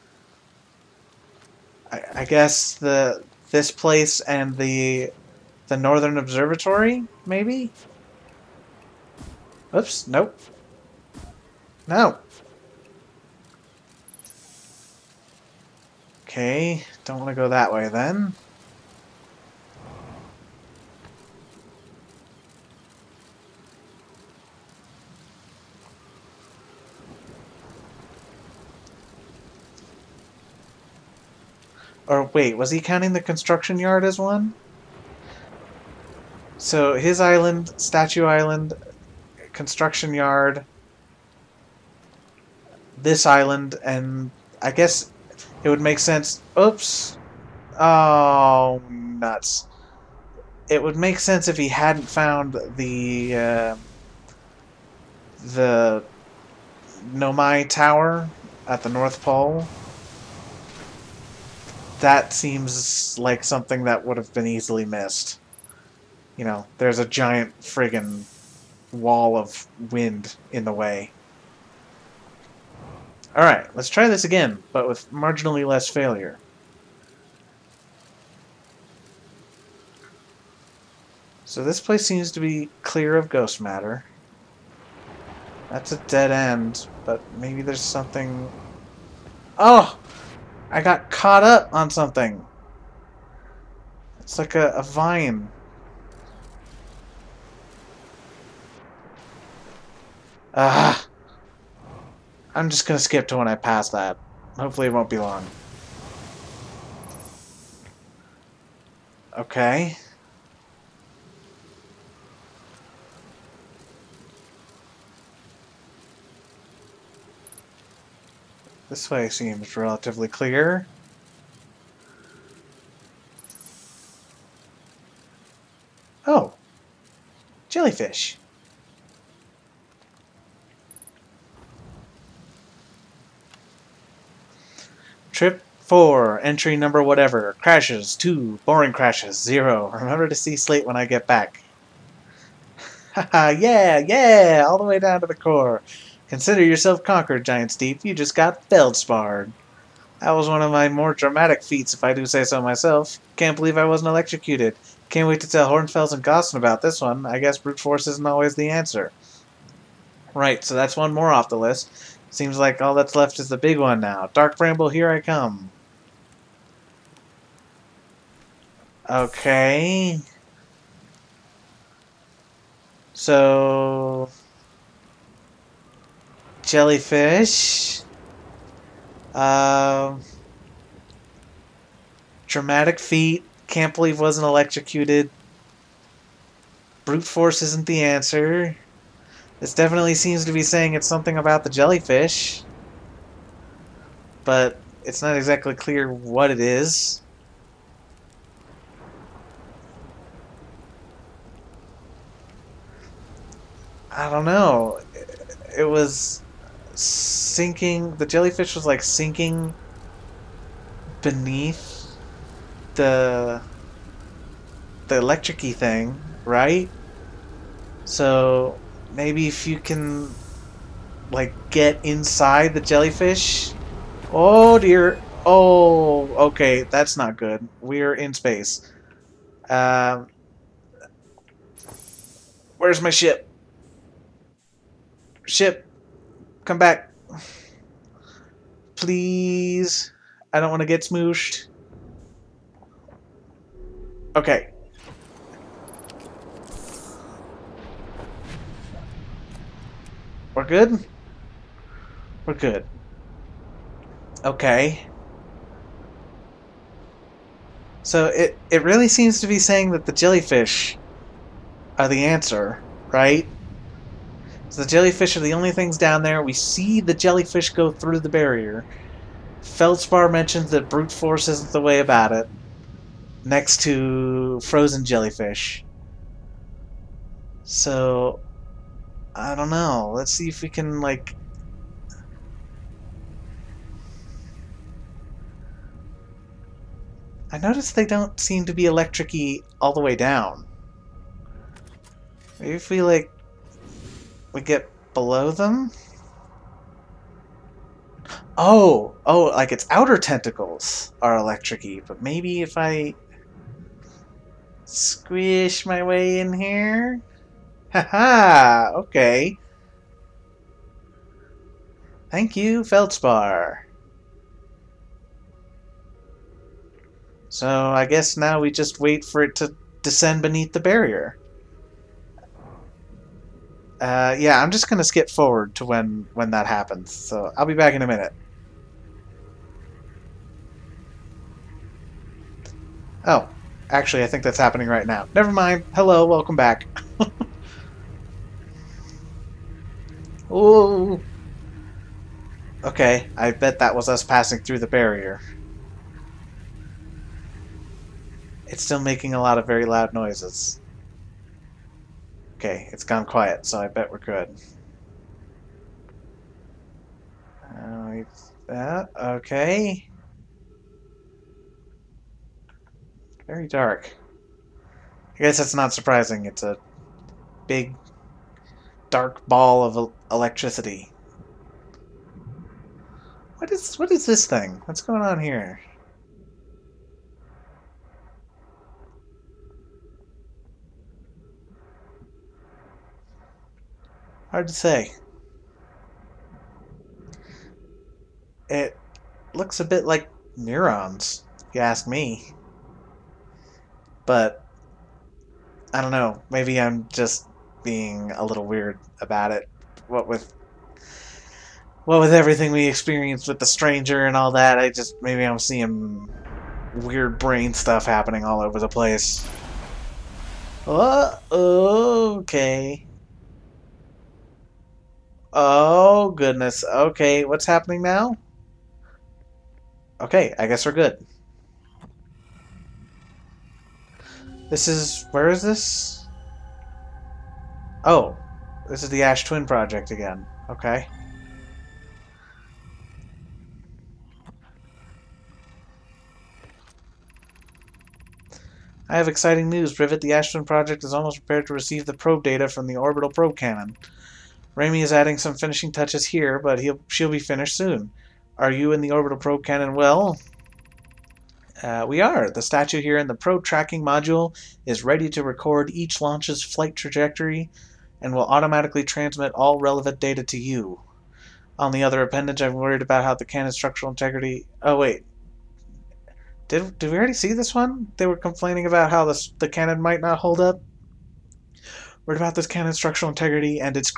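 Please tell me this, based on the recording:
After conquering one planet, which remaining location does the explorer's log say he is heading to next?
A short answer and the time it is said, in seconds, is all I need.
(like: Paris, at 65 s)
Dark Bramble, at 164 s.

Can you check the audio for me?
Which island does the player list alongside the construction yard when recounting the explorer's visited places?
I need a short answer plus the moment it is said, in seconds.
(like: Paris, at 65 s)
Statue Island, at 37 s.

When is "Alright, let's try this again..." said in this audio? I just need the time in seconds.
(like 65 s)
73 s.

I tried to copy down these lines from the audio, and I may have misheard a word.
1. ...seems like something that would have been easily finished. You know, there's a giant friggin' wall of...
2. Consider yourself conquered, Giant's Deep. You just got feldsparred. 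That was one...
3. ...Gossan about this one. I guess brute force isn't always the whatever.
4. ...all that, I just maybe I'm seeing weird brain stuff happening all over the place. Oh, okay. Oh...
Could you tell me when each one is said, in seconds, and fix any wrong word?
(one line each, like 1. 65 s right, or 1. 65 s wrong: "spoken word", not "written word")
1. 62 s wrong: "missed", not "finished"
2. 146 s right
3. 156 s wrong: "answer", not "whatever"
4. 404 s right.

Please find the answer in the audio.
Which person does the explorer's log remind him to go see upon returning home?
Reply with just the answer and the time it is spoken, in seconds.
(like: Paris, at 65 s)
Slate, at 140 s.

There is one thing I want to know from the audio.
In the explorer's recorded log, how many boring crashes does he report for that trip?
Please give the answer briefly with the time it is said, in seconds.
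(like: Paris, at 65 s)
0, at 138 s.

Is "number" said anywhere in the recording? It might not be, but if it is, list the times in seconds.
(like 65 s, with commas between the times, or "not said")
136 s.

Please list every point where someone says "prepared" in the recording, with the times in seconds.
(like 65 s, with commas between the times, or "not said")
441 s.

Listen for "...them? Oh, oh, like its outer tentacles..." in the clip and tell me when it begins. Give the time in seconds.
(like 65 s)
295 s.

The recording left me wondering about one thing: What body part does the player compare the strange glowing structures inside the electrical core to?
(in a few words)
Neurons.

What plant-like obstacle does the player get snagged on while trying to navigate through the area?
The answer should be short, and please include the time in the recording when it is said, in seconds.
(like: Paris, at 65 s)
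A vine, at 94 s.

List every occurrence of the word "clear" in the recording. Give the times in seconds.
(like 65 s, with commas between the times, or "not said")
82 s, 120 s, 195 s.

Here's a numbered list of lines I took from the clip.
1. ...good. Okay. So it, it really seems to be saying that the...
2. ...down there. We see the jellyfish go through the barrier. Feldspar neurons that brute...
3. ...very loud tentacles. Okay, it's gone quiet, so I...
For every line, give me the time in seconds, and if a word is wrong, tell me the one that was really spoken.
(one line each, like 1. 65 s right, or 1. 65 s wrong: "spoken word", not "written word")
1. 252 s right
2. 265 s wrong: "mentions", not "neurons"
3. 349 s wrong: "noises", not "tentacles".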